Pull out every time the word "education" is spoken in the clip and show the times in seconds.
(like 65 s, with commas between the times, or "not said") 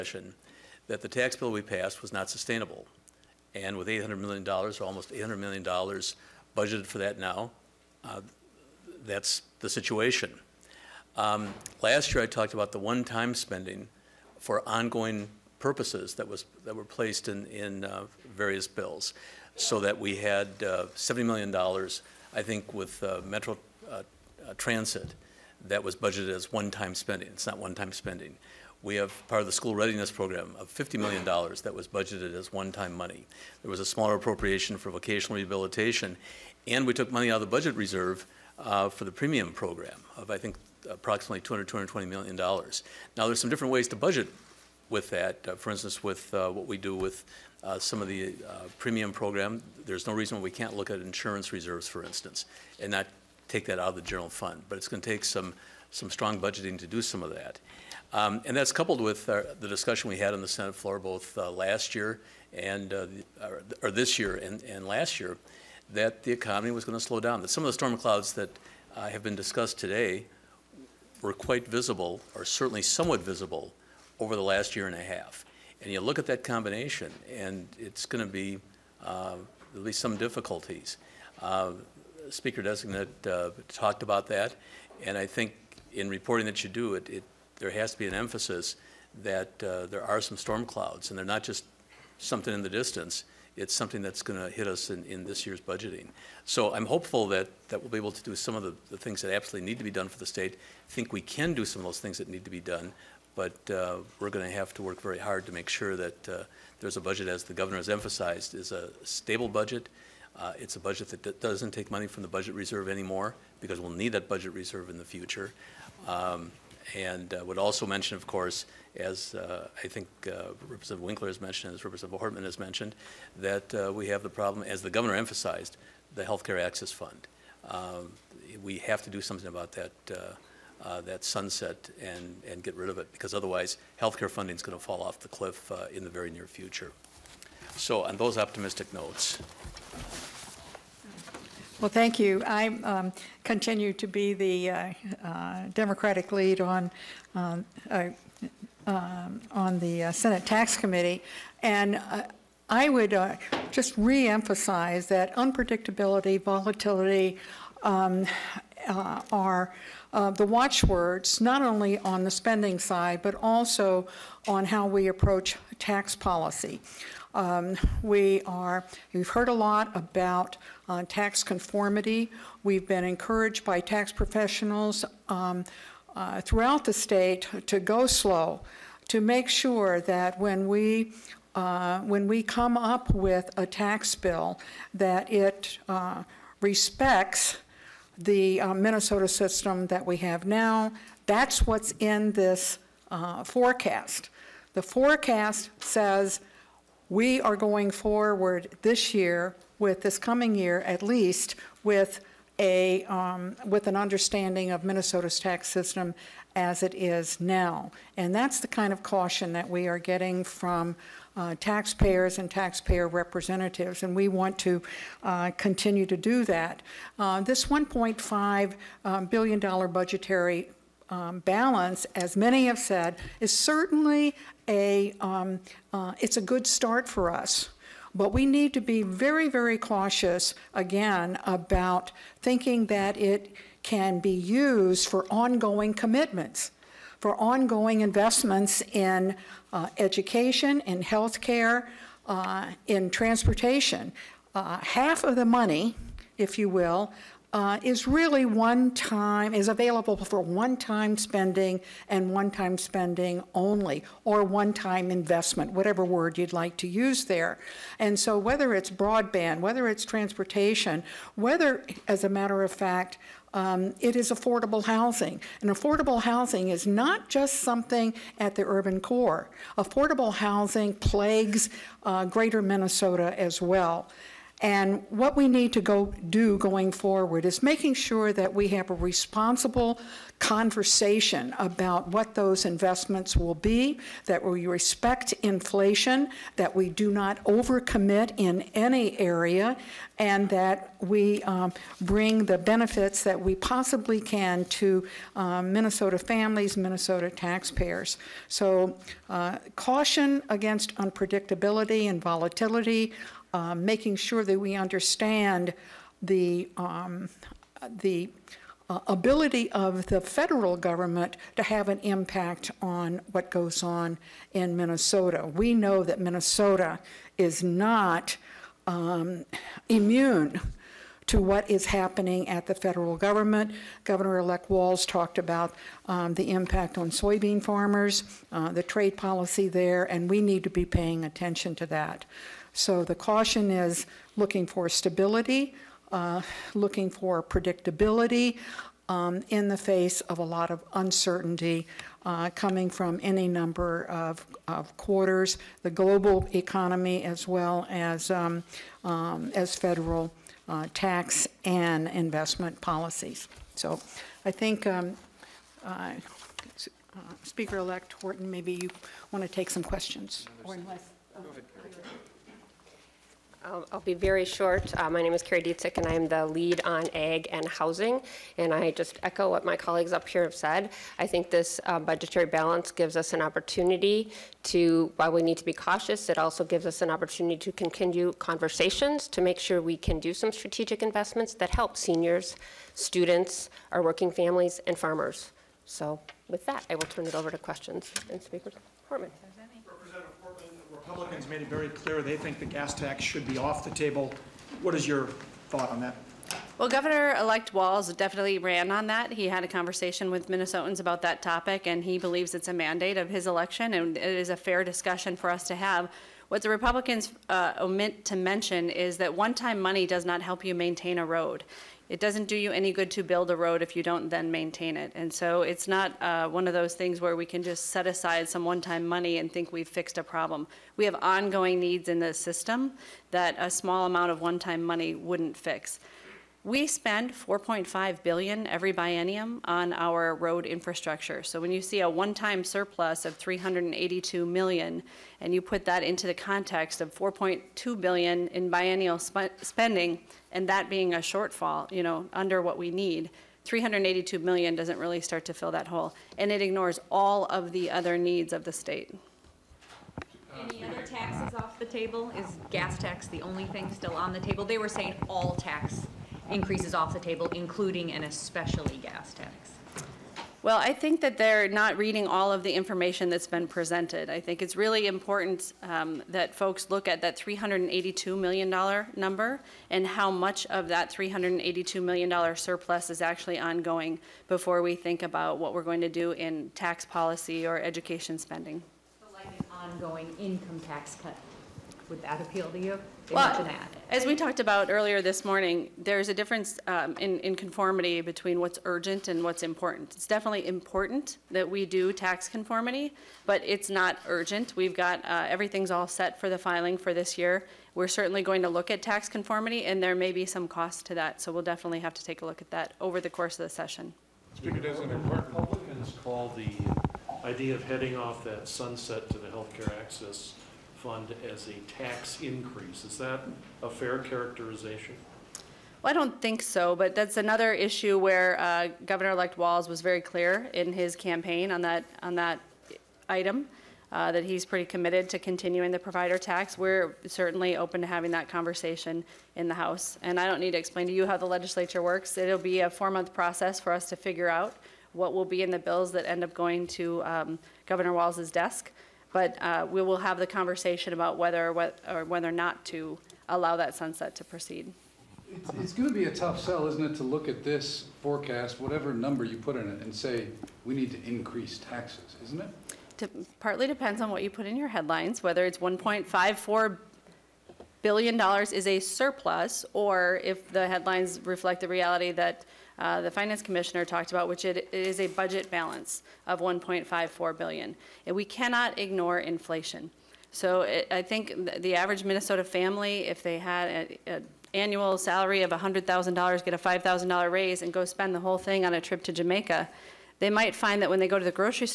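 239 s, 477 s.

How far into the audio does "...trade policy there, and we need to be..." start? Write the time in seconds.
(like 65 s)
328 s.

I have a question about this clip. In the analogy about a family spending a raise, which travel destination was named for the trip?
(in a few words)
Jamaica.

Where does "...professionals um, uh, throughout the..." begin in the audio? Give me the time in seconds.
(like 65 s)
174 s.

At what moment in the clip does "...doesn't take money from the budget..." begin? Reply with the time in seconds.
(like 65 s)
111 s.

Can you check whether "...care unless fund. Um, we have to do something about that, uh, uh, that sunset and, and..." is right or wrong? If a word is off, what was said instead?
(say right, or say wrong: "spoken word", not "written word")
wrong: "access", not "unless".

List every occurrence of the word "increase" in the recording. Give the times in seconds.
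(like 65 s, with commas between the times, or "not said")
456 s, 512 s, 551 s.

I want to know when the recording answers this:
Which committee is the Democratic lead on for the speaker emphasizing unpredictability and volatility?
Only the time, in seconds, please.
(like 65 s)
150 s.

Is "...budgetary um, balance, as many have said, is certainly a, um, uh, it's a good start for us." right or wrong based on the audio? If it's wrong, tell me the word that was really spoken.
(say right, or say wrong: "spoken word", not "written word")
right.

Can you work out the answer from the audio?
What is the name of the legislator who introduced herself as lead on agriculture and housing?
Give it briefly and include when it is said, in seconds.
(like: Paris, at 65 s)
Kari Dziedzic, at 365 s.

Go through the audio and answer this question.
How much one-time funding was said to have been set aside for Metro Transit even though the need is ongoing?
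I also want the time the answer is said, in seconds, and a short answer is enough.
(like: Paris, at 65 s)
$70 million, at 20 s.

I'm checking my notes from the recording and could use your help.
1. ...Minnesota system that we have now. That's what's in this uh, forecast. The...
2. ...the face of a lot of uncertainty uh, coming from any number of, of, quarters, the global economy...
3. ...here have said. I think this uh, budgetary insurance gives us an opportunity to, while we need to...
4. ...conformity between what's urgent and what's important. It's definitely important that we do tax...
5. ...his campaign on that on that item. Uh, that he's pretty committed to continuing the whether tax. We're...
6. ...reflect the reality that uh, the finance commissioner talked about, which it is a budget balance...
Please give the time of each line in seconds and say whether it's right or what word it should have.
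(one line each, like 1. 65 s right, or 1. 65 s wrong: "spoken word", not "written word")
1. 188 s right
2. 339 s right
3. 370 s wrong: "balance", not "insurance"
4. 487 s right
5. 520 s wrong: "provider", not "whether"
6. 561 s right.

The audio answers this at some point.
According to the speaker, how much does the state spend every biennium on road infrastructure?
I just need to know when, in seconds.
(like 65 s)
427 s.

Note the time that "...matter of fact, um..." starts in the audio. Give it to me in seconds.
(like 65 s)
262 s.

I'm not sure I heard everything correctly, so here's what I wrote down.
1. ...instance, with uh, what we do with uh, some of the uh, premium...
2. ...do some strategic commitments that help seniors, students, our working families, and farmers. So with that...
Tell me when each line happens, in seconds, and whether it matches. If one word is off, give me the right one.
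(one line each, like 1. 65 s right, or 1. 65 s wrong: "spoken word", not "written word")
1. 45 s right
2. 380 s wrong: "investments", not "commitments".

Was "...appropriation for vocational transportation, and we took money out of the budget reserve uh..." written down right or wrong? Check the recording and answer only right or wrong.
wrong.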